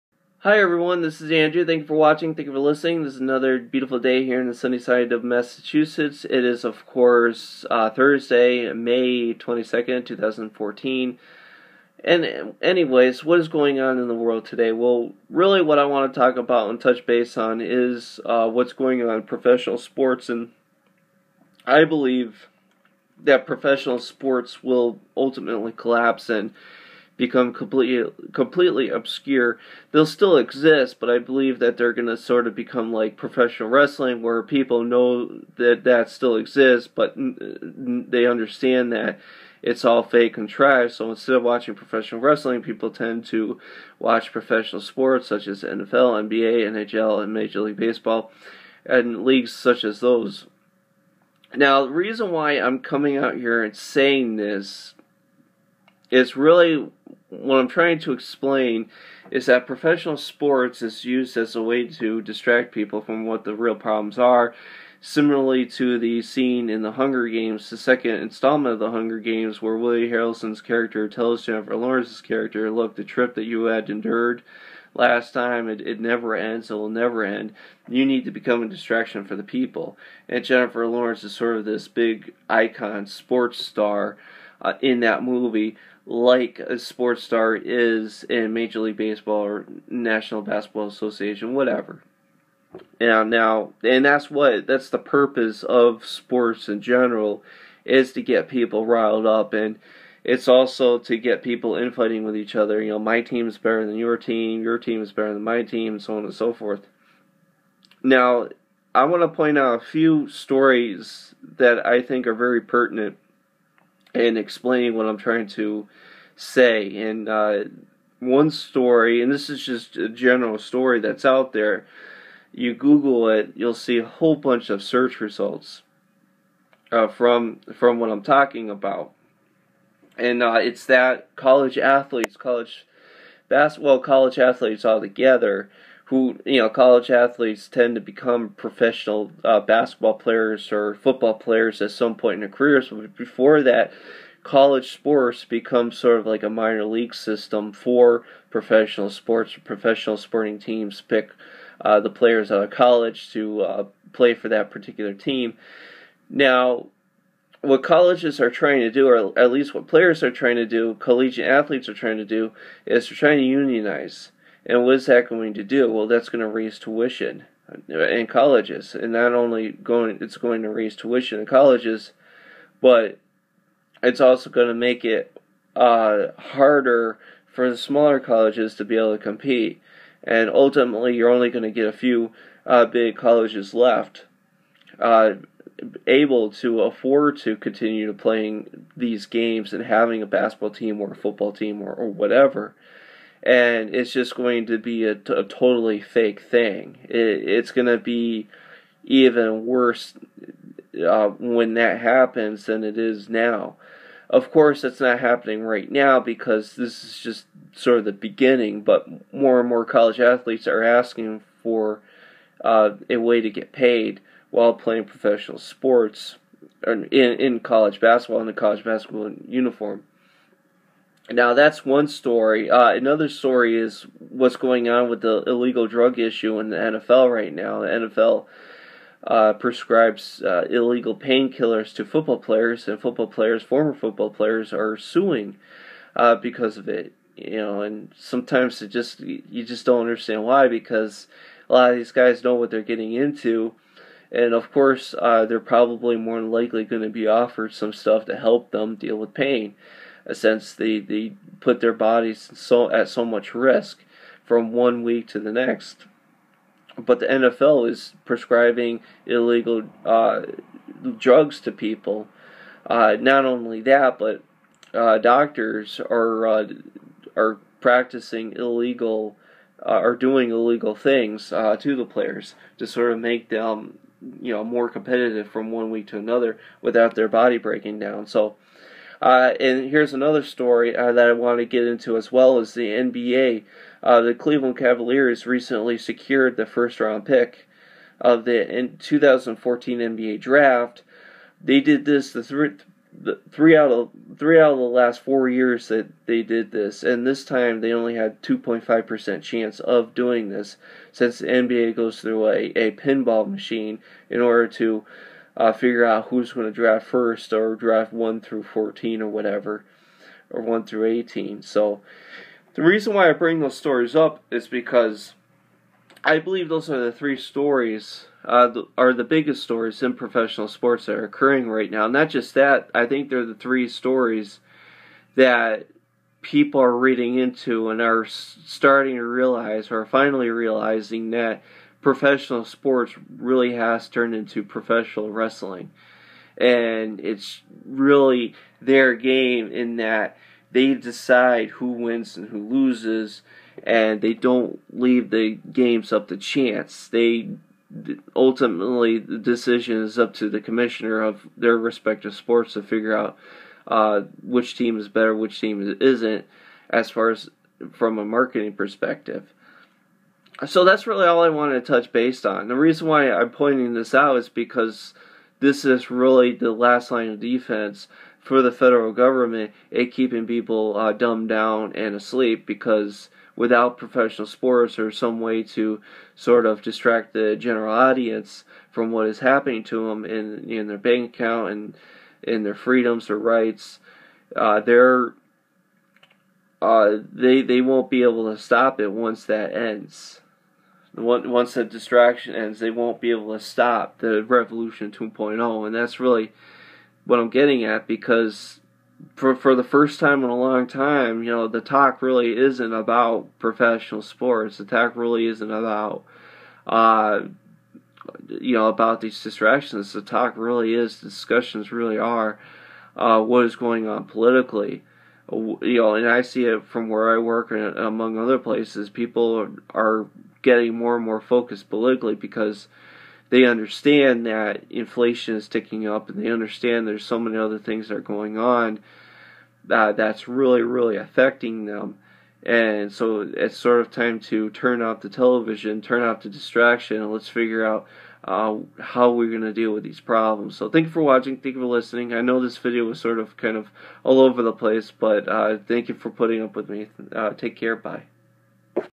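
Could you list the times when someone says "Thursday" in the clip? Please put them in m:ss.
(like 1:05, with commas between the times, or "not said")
0:07.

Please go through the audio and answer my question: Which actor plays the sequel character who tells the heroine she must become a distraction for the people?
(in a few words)
Willie Harrelson.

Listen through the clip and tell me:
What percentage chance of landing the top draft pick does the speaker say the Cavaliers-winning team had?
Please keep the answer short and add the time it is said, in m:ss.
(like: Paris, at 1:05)
2.5 percent, at 4:58.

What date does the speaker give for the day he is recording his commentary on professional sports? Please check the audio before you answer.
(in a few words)
May 22nd, 2014.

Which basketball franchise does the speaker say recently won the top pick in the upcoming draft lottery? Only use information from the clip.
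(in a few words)
Cleveland Cavaliers.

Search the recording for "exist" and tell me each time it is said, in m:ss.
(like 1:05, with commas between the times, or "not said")
0:30, 0:36.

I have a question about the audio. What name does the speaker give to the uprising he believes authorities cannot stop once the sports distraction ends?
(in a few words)
Revolution 2.0.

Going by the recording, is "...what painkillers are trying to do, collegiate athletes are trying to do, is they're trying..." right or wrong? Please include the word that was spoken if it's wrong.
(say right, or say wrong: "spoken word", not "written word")
wrong: "players", not "painkillers".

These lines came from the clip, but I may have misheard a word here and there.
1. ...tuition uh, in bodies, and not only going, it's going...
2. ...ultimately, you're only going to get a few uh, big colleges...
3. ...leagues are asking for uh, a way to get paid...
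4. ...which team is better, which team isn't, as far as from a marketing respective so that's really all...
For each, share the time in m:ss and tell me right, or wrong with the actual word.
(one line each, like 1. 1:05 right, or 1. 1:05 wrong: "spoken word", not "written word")
1. 2:46 wrong: "colleges", not "bodies"
2. 3:00 right
3. 3:30 wrong: "athletes", not "leagues"
4. 5:54 wrong: "perspective", not "respective".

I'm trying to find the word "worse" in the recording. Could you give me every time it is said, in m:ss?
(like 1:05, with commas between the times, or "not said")
3:19.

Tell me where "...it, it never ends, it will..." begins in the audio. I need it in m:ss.
1:15.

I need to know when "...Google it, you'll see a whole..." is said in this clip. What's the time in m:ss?
2:02.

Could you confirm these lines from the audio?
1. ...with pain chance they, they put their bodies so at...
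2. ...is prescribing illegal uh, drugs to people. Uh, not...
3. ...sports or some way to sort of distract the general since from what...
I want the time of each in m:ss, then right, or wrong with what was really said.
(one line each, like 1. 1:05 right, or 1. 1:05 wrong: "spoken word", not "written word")
1. 4:09 wrong: "since", not "chance"
2. 4:17 right
3. 6:14 wrong: "audience", not "since".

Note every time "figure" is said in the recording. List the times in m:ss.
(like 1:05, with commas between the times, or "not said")
5:05, 5:52, 7:17.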